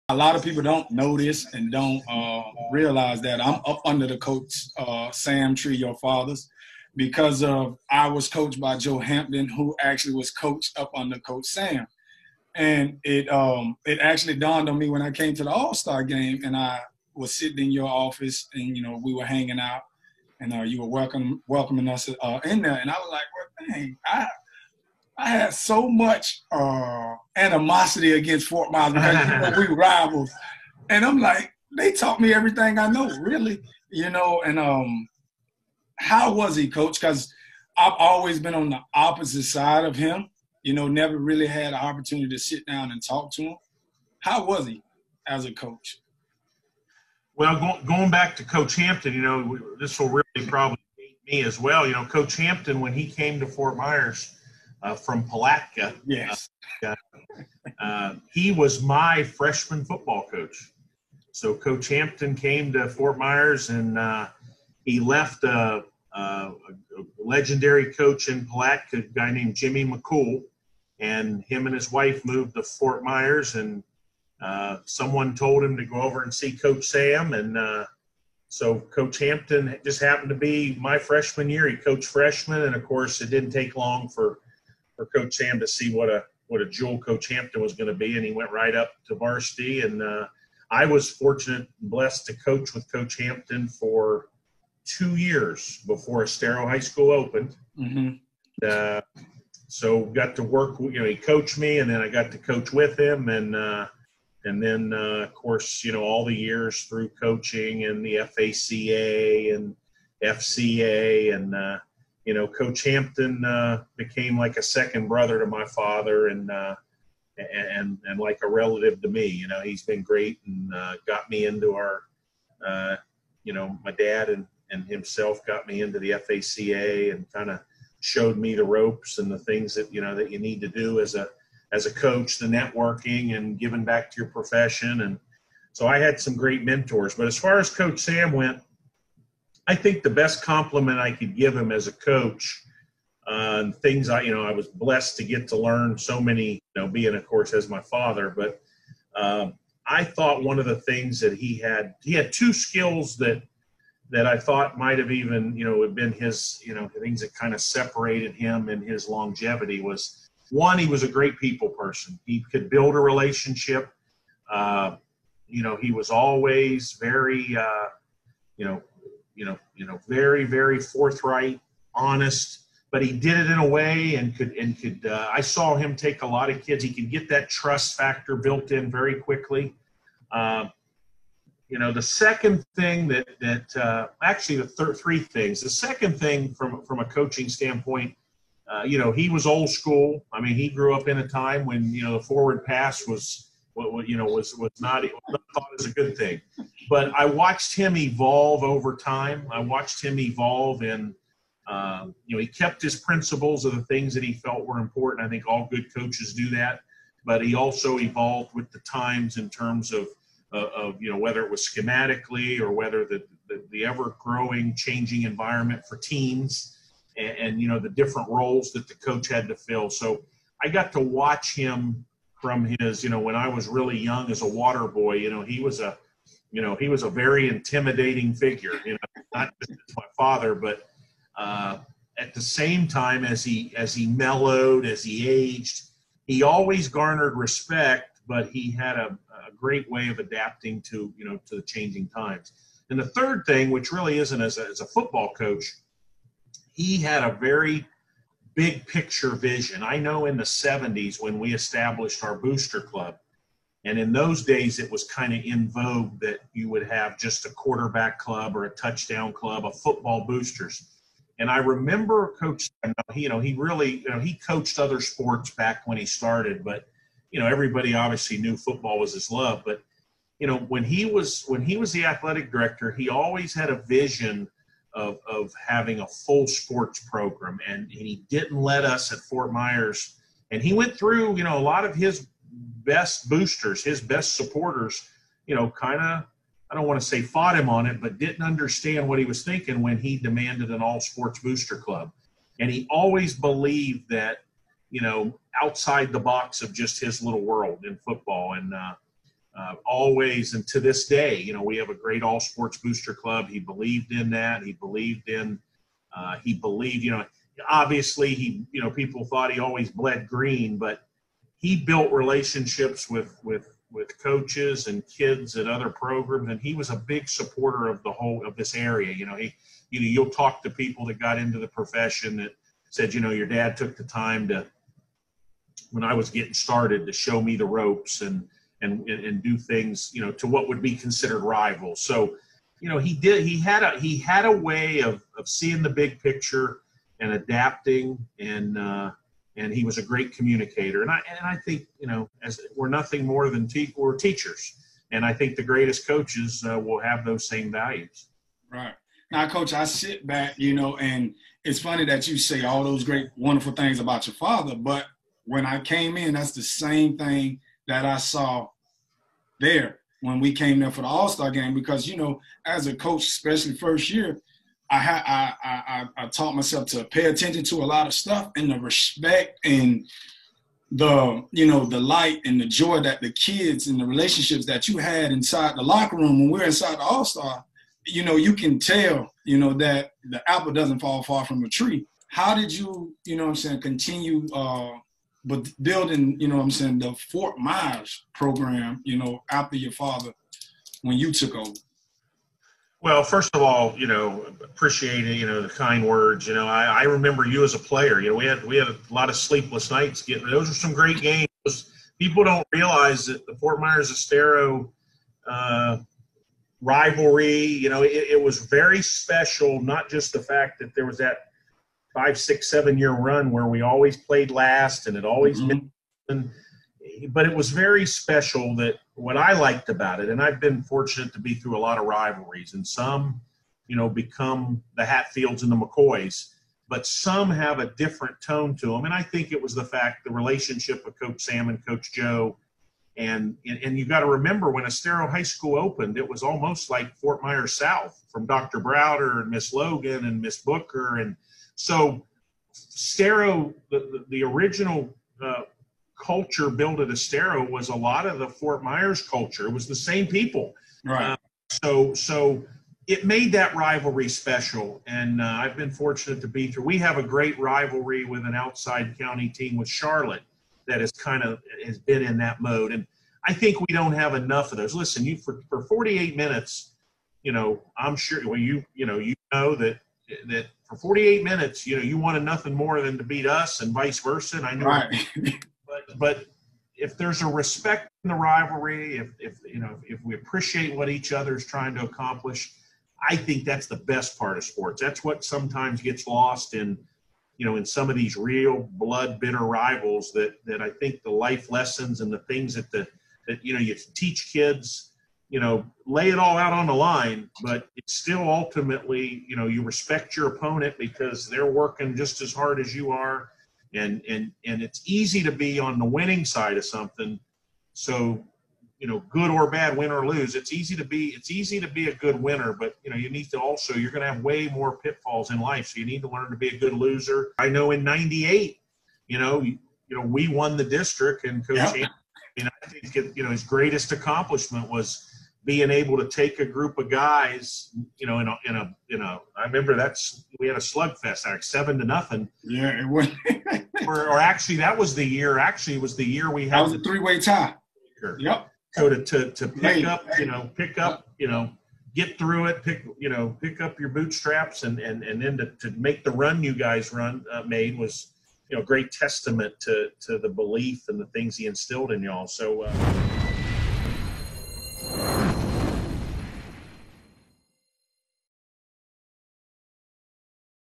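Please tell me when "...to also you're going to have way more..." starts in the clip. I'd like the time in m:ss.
8:33.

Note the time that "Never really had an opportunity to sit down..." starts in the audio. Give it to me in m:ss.
0:40.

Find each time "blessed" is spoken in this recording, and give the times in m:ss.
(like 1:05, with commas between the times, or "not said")
1:31, 2:24.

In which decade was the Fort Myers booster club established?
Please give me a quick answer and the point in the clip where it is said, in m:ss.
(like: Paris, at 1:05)
1970s, at 4:10.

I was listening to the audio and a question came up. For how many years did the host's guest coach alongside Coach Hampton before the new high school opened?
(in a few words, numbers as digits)
2.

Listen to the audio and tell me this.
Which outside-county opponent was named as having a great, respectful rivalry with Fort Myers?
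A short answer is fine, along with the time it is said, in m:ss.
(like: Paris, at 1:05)
Charlotte, at 7:39.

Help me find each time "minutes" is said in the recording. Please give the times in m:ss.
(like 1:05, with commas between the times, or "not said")
7:46, 7:51.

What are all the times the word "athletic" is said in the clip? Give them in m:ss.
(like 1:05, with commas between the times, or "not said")
4:32.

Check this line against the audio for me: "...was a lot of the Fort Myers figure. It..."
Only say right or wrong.
wrong.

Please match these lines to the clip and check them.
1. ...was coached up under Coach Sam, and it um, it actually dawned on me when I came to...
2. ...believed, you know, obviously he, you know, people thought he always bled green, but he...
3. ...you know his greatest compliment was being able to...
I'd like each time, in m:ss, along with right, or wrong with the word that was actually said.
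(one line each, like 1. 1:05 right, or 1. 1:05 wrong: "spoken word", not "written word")
1. 0:10 right
2. 5:06 right
3. 8:43 wrong: "accomplishment", not "compliment".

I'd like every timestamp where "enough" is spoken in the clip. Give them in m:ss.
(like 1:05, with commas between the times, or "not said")
7:44.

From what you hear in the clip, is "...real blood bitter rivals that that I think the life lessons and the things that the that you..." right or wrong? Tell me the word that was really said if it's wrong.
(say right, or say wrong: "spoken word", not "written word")
right.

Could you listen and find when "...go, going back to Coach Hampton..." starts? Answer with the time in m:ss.
0:47.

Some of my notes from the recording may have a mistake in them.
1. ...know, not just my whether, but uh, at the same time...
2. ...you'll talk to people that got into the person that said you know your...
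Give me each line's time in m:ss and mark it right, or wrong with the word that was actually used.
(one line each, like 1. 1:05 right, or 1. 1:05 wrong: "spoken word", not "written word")
1. 3:48 wrong: "father", not "whether"
2. 5:20 wrong: "profession", not "person".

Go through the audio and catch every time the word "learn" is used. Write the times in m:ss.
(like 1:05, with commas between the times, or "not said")
2:25, 8:36.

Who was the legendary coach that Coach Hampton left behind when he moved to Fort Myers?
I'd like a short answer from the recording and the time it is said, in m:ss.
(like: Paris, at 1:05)
Jimmy McCool, at 1:09.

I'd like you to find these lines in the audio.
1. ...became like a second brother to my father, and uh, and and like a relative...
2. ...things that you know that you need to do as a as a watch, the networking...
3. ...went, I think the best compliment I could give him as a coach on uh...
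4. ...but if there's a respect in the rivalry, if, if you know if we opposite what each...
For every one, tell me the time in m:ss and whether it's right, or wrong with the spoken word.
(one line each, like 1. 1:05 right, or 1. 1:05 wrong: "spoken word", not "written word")
1. 1:53 right
2. 2:09 wrong: "coach", not "watch"
3. 2:18 right
4. 7:56 wrong: "appreciate", not "opposite".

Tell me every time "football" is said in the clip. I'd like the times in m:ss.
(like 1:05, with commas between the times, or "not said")
0:59, 4:04, 4:19, 4:28, 4:58.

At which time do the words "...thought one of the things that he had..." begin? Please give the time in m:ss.
2:30.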